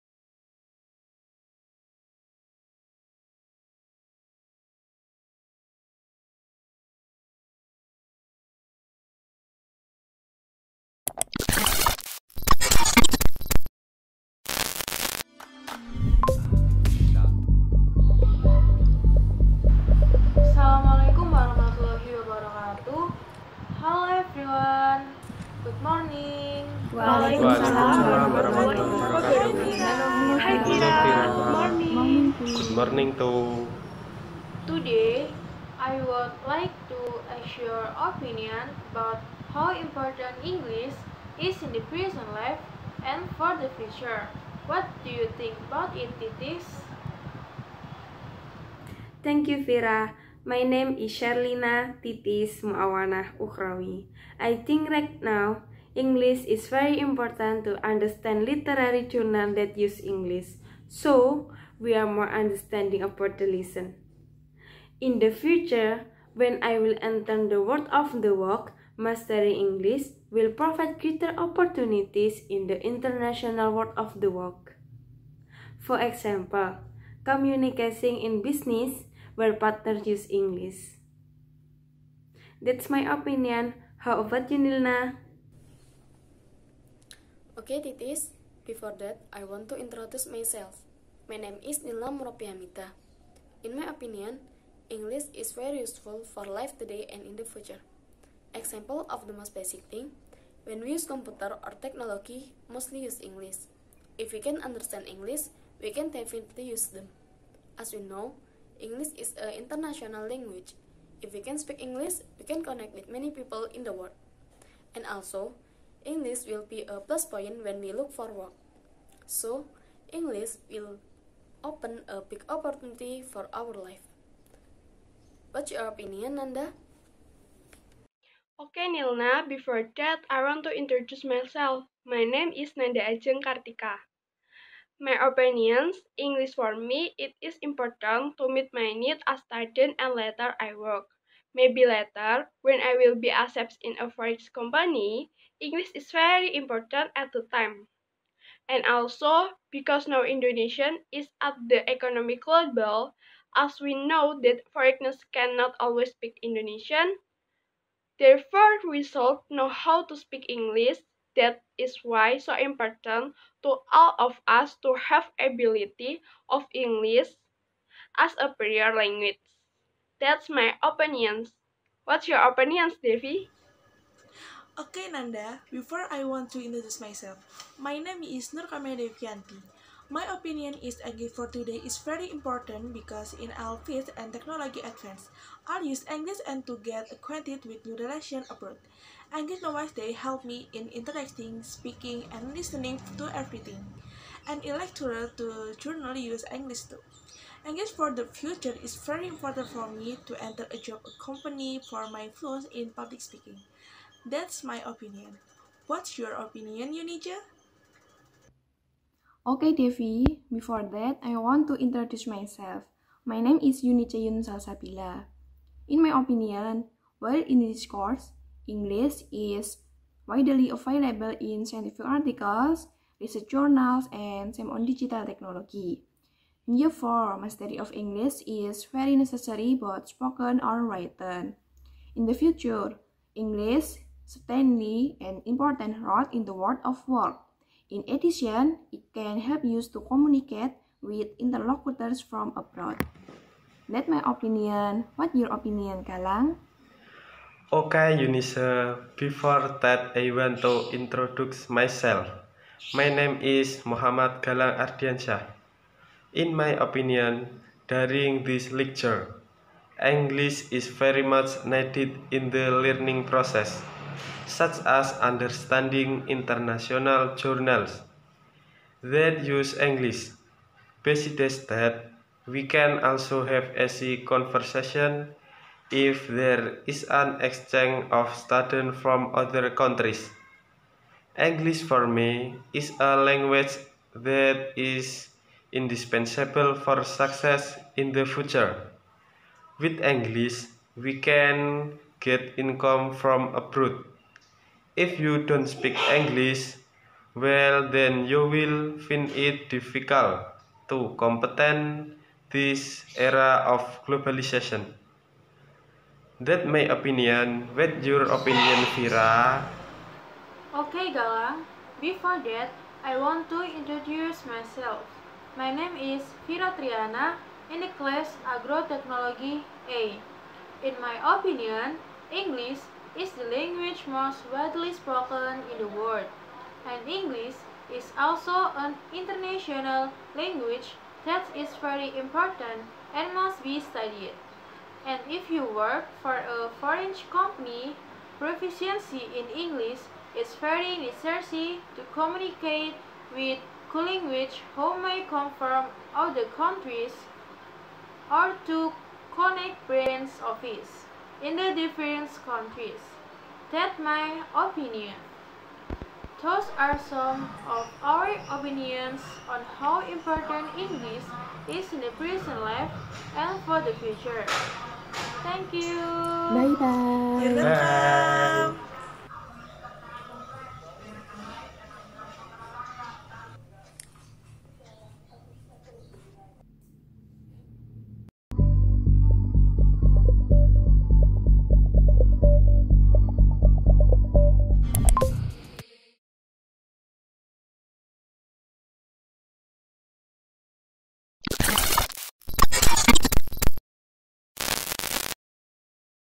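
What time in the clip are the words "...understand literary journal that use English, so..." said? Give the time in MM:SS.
00:57.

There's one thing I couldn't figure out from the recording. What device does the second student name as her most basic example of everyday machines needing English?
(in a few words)
computer.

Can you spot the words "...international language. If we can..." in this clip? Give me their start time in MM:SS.
01:49.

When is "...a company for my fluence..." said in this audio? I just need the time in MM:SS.
03:21.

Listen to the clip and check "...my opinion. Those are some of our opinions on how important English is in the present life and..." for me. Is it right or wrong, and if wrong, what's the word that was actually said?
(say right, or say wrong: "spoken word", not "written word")
right.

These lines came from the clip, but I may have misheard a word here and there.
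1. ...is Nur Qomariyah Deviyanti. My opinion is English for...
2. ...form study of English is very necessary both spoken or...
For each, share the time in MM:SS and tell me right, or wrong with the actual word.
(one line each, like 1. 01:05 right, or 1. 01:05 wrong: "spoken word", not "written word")
1. 02:58 right
2. 03:46 right.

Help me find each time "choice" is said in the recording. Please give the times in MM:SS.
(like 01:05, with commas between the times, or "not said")
not said.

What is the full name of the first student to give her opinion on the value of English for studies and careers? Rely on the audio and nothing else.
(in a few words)
Sherlina Titis Muawana Ukrawi.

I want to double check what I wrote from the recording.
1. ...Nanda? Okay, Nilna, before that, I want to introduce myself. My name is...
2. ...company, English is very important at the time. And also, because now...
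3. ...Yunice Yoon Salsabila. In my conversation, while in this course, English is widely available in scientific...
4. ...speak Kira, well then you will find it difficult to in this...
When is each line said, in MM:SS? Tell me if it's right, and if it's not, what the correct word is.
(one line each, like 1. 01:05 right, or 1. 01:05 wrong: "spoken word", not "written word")
1. 02:06 right
2. 02:24 right
3. 03:33 wrong: "opinion", not "conversation"
4. 04:55 wrong: "English", not "Kira".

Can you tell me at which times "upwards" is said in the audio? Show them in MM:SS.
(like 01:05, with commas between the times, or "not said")
not said.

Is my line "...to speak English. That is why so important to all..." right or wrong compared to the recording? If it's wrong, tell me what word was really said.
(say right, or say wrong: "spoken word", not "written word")
right.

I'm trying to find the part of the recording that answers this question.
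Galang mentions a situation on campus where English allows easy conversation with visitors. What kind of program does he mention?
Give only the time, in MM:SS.
04:37.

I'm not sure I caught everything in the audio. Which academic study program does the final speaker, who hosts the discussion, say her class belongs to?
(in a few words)
Agrotechnology.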